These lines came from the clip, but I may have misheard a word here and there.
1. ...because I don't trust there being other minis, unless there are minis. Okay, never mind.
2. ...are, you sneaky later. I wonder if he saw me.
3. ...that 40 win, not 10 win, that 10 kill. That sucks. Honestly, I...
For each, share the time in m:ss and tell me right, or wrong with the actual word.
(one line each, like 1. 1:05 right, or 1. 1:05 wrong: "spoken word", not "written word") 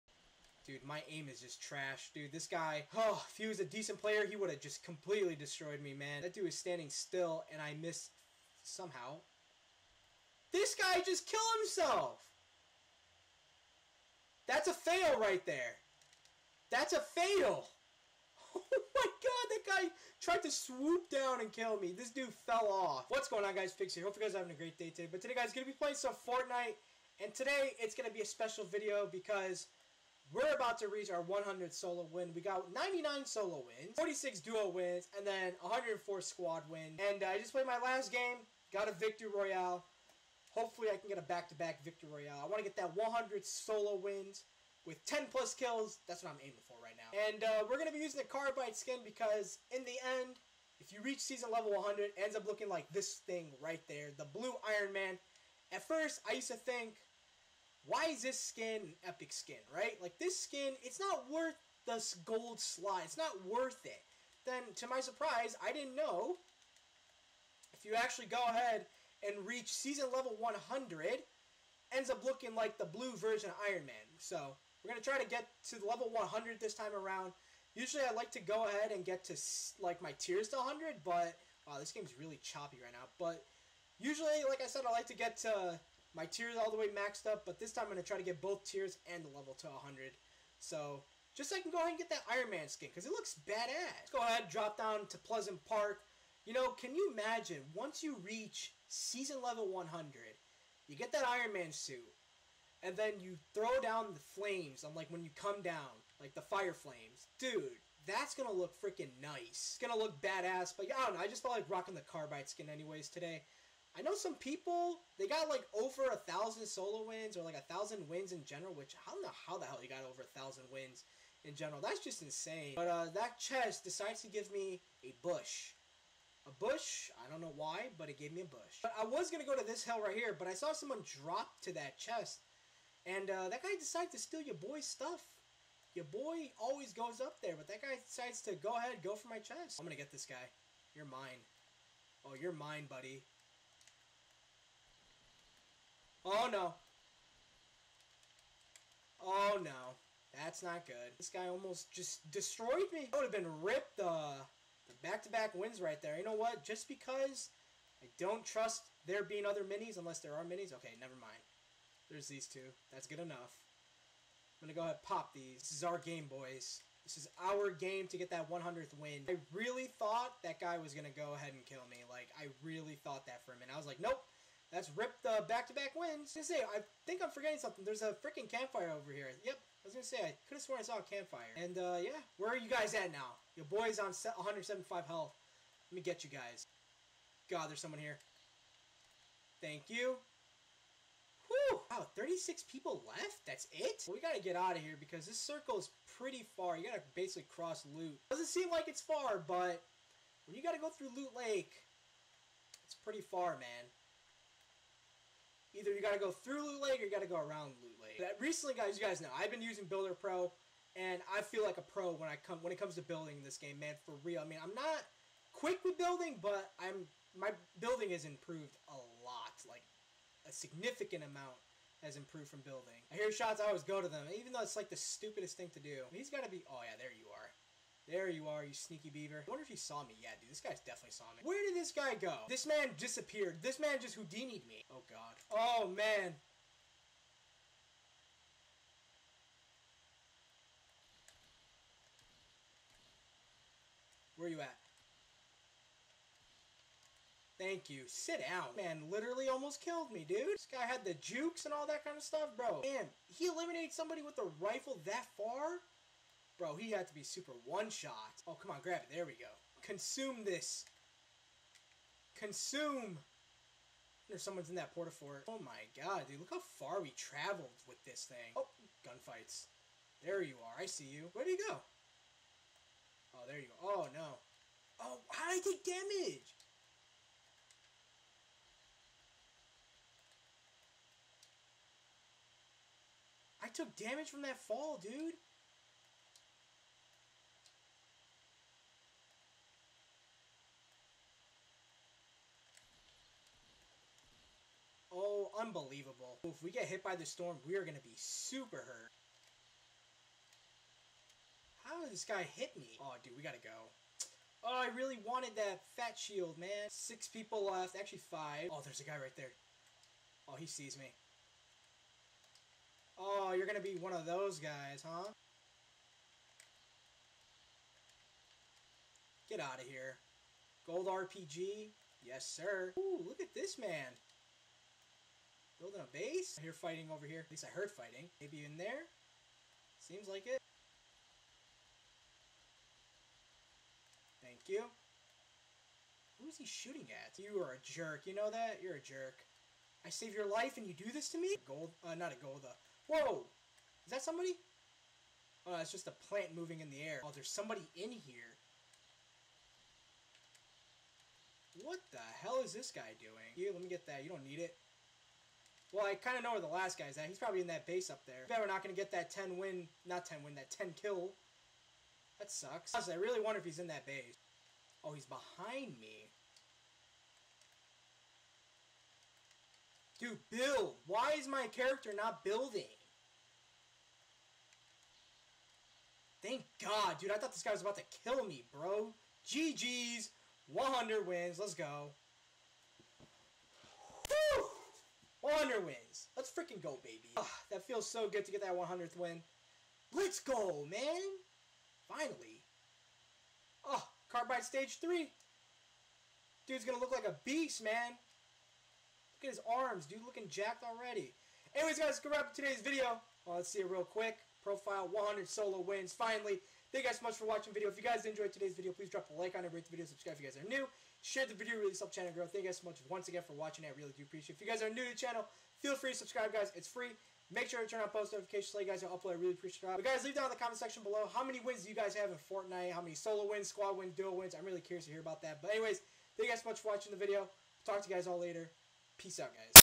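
1. 2:36 right
2. 3:48 wrong: "beaver", not "later"
3. 5:59 wrong: "10", not "40".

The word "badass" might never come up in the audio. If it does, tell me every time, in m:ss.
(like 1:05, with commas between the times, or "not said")
1:33, 1:50.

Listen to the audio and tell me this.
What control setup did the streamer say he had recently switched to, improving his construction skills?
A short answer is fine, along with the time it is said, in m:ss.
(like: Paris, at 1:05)
Builder Pro, at 3:29.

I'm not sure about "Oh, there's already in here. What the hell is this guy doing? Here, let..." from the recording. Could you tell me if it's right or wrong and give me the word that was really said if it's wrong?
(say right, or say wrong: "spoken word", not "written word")
wrong: "somebody", not "already".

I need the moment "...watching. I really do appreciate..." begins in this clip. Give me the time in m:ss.
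6:53.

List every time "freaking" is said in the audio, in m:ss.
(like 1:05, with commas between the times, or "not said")
1:48, 2:58, 6:26.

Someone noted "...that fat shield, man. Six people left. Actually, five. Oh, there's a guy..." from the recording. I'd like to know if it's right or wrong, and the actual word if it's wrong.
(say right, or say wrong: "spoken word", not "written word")
right.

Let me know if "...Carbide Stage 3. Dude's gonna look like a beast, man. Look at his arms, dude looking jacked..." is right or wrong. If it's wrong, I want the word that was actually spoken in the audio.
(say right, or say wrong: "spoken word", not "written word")
right.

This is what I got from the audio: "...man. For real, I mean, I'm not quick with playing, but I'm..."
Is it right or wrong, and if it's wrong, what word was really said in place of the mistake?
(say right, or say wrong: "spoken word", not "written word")
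wrong: "building", not "playing".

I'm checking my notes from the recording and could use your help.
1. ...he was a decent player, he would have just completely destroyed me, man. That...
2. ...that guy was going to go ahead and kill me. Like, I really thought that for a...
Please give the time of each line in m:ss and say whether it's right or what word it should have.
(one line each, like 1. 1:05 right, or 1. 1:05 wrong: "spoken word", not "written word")
1. 0:03 right
2. 2:50 right.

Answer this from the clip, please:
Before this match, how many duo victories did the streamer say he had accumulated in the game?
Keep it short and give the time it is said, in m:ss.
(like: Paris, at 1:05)
46, at 0:33.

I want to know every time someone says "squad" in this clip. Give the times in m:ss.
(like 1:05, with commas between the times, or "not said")
0:36, 7:03.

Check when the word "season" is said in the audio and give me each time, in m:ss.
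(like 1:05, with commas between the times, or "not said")
0:51, 1:09, 1:38.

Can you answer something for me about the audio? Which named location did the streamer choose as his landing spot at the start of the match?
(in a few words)
Pleasant Park.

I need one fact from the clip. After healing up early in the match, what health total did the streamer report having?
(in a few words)
175.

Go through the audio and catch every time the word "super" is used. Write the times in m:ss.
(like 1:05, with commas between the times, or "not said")
4:17, 4:58.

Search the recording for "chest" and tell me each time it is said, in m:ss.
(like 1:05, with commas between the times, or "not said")
2:03, 2:11, 2:19.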